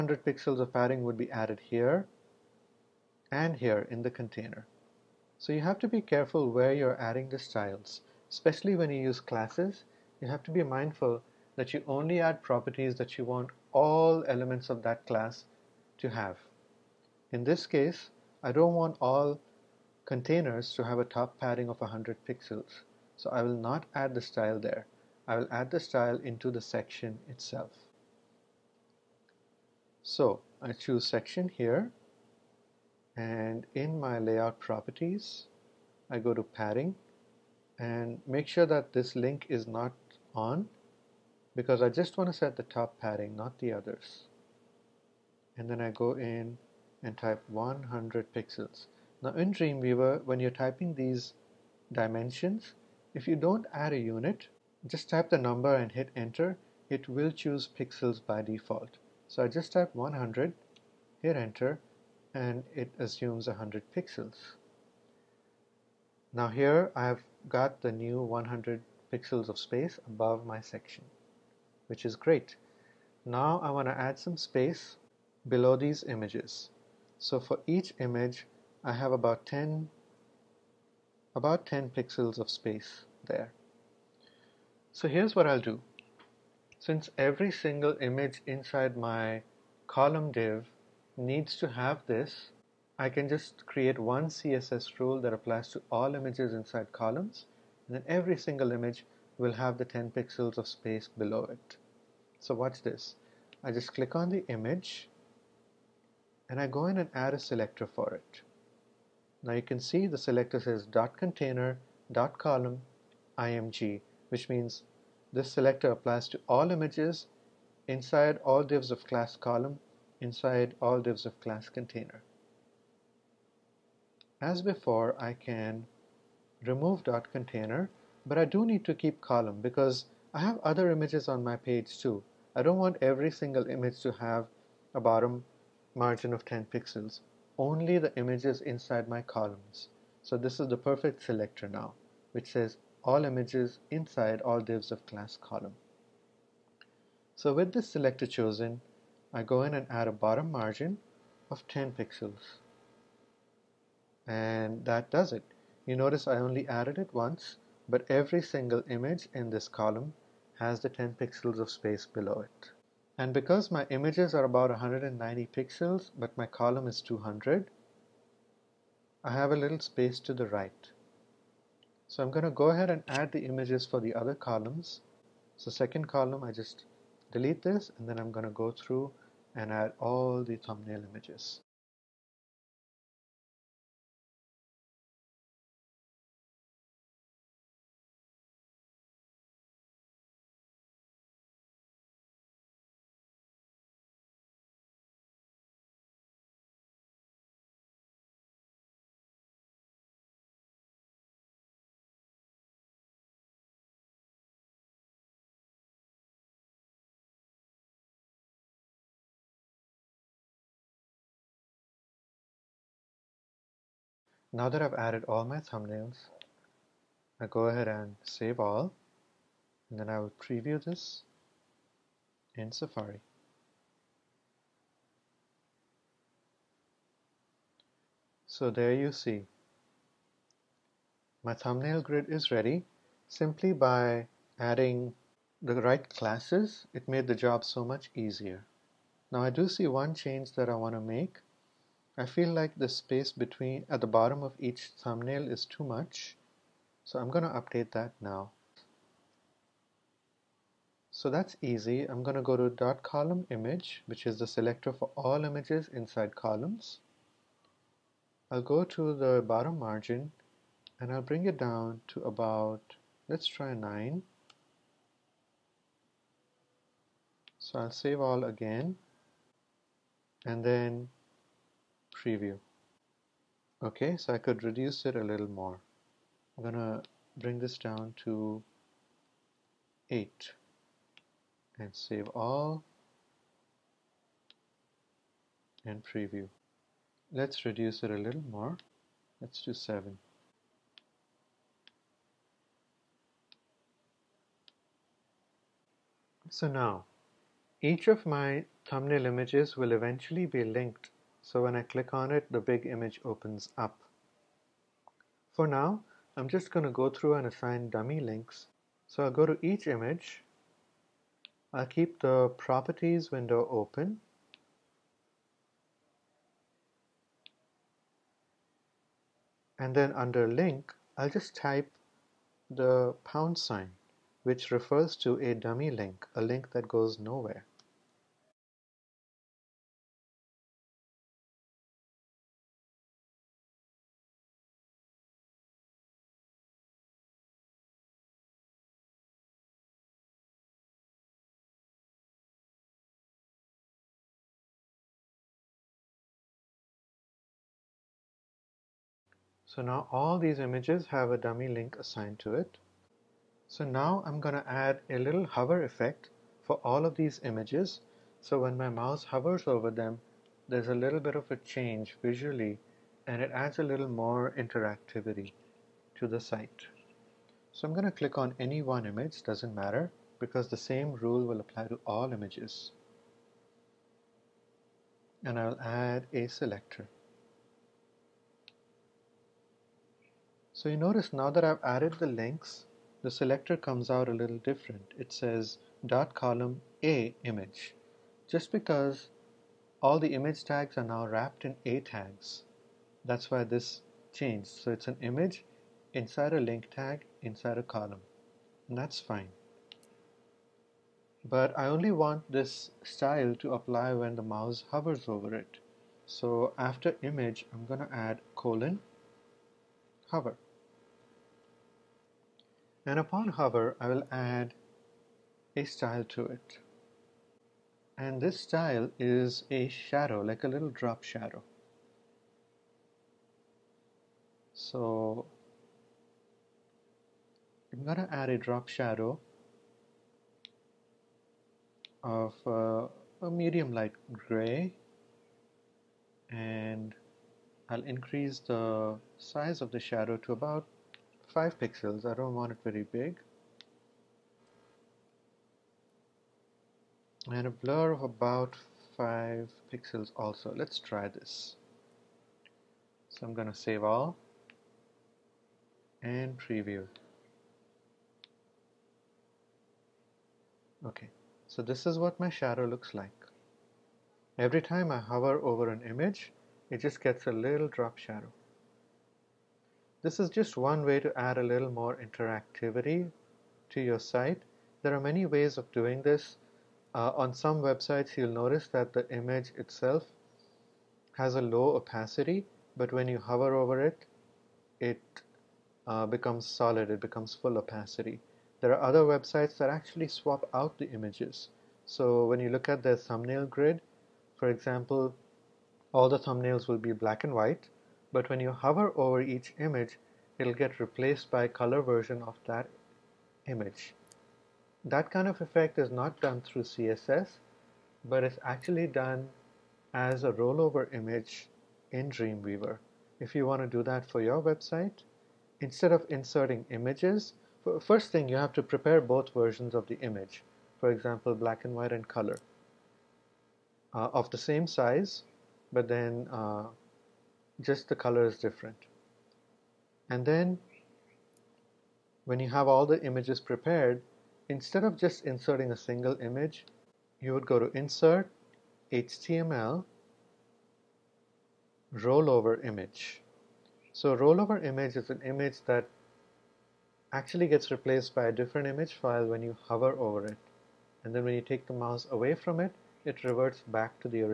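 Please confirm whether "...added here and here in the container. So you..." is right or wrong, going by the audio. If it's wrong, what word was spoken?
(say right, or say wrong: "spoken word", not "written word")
right.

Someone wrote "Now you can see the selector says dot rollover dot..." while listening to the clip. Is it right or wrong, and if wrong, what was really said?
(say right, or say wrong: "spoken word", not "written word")
wrong: "container", not "rollover".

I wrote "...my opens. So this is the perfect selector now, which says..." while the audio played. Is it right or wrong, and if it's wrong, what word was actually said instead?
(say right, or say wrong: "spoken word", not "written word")
wrong: "columns", not "opens".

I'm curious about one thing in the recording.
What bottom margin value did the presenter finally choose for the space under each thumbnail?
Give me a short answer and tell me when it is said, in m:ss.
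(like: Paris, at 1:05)
7, at 4:49.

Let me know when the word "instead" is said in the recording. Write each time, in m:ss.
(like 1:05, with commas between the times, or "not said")
8:35, 8:54.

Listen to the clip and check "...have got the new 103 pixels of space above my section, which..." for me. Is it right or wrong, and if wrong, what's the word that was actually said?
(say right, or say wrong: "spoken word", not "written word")
wrong: "100", not "103".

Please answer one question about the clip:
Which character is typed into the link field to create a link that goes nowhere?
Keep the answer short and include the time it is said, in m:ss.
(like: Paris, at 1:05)
pound sign, at 5:23.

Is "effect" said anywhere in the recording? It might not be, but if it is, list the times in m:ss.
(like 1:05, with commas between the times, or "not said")
5:55, 8:25.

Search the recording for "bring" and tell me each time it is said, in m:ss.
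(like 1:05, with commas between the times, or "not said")
4:21, 4:37.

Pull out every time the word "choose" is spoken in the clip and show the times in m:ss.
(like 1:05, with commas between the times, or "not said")
0:30, 0:57.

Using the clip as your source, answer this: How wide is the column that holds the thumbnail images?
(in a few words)
200.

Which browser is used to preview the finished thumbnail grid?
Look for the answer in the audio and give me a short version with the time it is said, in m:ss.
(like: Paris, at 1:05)
Safari, at 3:42.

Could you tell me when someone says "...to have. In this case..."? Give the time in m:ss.
0:15.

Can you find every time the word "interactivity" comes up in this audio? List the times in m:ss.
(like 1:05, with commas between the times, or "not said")
6:04, 7:52.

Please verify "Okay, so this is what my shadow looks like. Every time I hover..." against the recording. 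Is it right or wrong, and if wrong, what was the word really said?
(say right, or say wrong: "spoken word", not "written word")
right.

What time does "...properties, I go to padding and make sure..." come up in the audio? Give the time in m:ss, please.
0:34.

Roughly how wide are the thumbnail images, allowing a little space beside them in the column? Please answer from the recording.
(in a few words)
190 pixels.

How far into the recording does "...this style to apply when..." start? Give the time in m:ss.
6:42.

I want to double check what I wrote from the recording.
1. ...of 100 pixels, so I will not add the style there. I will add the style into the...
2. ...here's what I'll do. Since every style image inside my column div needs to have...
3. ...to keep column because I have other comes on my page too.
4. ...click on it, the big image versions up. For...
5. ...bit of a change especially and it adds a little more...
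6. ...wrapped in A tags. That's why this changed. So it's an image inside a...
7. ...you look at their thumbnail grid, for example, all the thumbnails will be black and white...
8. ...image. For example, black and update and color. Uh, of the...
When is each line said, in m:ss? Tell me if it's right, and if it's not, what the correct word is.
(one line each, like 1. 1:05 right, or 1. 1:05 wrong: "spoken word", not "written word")
1. 0:21 right
2. 1:25 wrong: "single", not "style"
3. 2:08 wrong: "images", not "comes"
4. 5:01 wrong: "opens", not "versions"
5. 6:01 wrong: "visually", not "especially"
6. 6:31 right
7. 8:12 right
8. 8:40 wrong: "white", not "update".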